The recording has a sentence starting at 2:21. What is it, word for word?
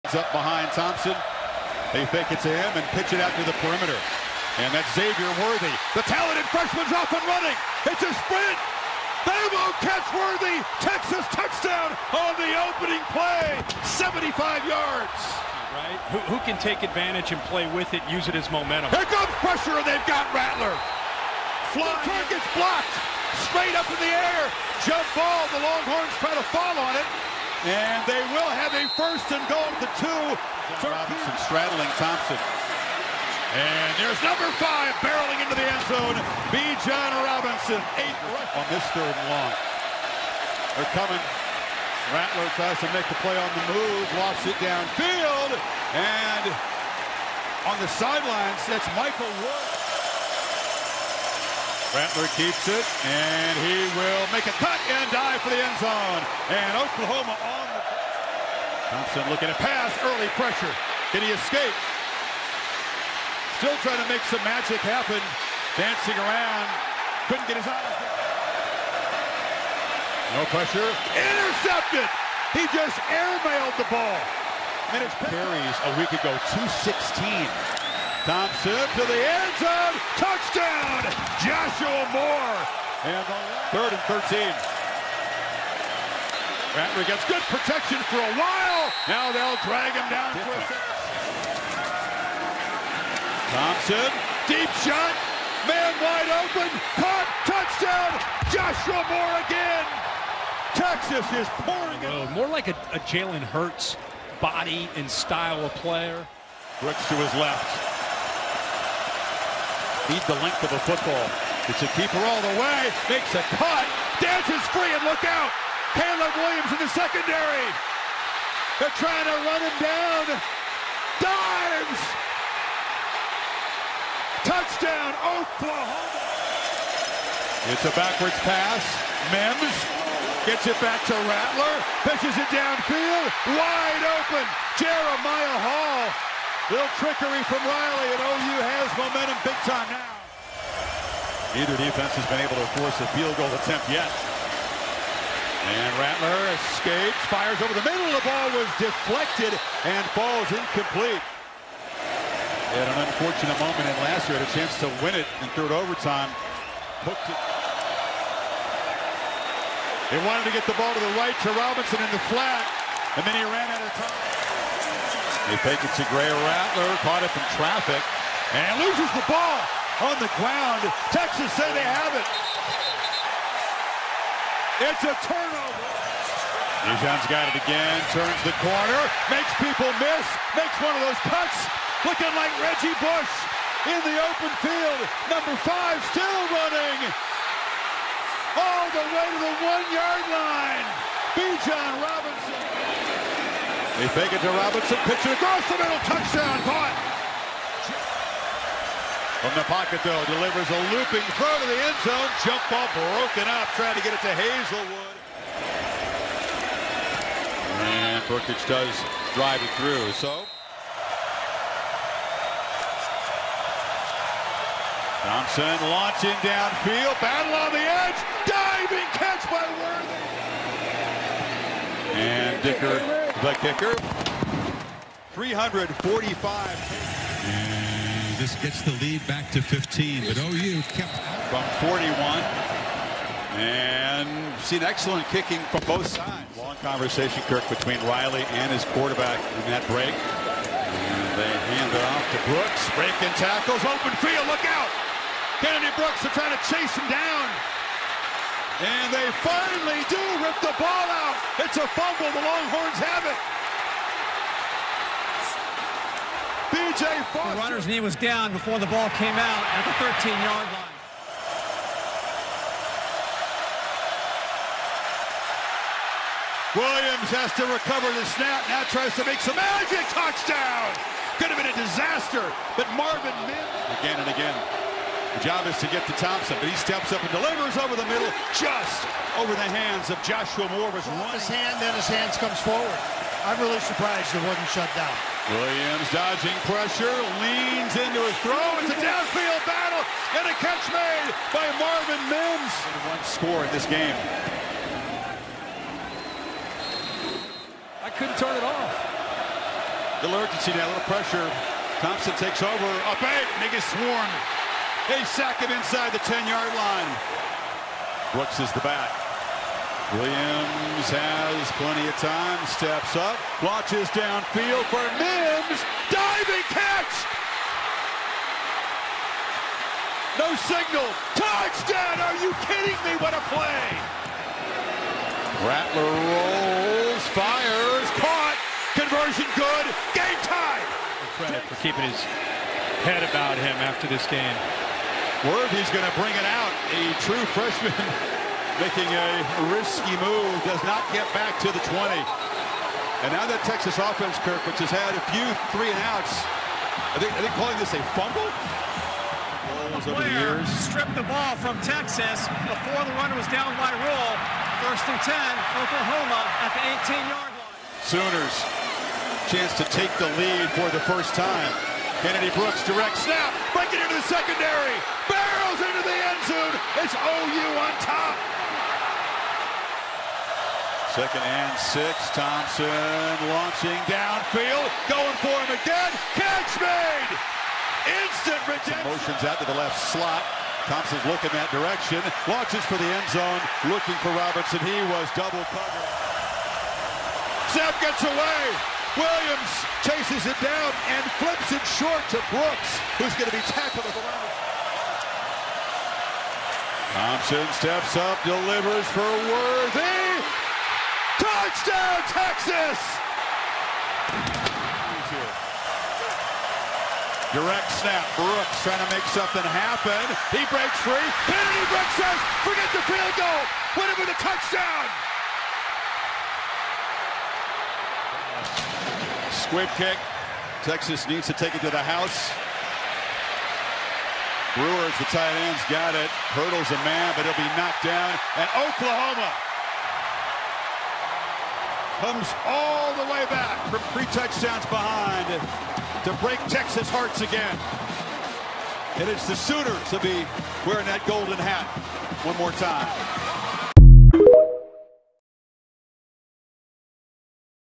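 Neither defense has been able to force a field goal attempt yet.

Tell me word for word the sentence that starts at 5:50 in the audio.
Stripped the ball from Texas before the runner was down by rule.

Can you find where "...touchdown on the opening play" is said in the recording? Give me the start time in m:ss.
0:11.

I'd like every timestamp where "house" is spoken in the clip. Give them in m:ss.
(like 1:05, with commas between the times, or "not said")
7:02.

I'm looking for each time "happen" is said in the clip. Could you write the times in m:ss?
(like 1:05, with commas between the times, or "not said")
1:04, 6:49.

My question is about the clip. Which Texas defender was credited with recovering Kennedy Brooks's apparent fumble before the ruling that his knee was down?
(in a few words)
B.J. Foster.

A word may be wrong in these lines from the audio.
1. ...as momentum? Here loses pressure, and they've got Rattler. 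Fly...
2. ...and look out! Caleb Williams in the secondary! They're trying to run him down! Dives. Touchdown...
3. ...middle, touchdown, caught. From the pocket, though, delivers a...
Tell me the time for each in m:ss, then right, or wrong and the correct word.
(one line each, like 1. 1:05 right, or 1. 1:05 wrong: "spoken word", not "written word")
1. 0:18 wrong: "comes", not "loses"
2. 1:54 right
3. 3:15 right.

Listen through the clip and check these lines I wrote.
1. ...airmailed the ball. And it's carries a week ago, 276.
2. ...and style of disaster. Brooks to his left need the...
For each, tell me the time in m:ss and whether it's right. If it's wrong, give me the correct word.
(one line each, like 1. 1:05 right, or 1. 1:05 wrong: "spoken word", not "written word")
1. 1:13 wrong: "216", not "276"
2. 1:44 wrong: "player", not "disaster".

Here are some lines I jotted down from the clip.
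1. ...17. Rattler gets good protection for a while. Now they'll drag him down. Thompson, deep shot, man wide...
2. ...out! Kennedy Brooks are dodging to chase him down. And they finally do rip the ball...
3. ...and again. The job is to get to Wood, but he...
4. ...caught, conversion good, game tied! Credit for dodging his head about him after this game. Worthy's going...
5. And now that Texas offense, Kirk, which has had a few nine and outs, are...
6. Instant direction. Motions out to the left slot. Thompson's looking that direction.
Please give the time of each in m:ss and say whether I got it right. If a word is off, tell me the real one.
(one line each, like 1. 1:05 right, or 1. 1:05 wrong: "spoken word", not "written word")
1. 1:24 wrong: "13", not "17"
2. 4:04 wrong: "trying", not "dodging"
3. 4:34 wrong: "Thompson", not "Wood"
4. 5:28 wrong: "keeping", not "dodging"
5. 5:43 wrong: "three", not "nine"
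6. 6:18 wrong: "redemption", not "direction".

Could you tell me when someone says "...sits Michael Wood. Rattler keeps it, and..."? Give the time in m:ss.
0:48.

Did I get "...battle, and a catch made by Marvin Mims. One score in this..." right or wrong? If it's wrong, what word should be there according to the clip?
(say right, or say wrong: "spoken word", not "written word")
right.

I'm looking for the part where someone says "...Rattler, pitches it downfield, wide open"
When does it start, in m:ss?
2:11.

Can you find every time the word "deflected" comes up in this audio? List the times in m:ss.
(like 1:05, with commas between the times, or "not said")
2:28.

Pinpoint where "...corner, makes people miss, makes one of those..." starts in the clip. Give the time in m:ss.
2:58.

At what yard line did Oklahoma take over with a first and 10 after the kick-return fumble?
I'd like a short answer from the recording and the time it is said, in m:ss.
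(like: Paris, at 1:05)
18, at 5:57.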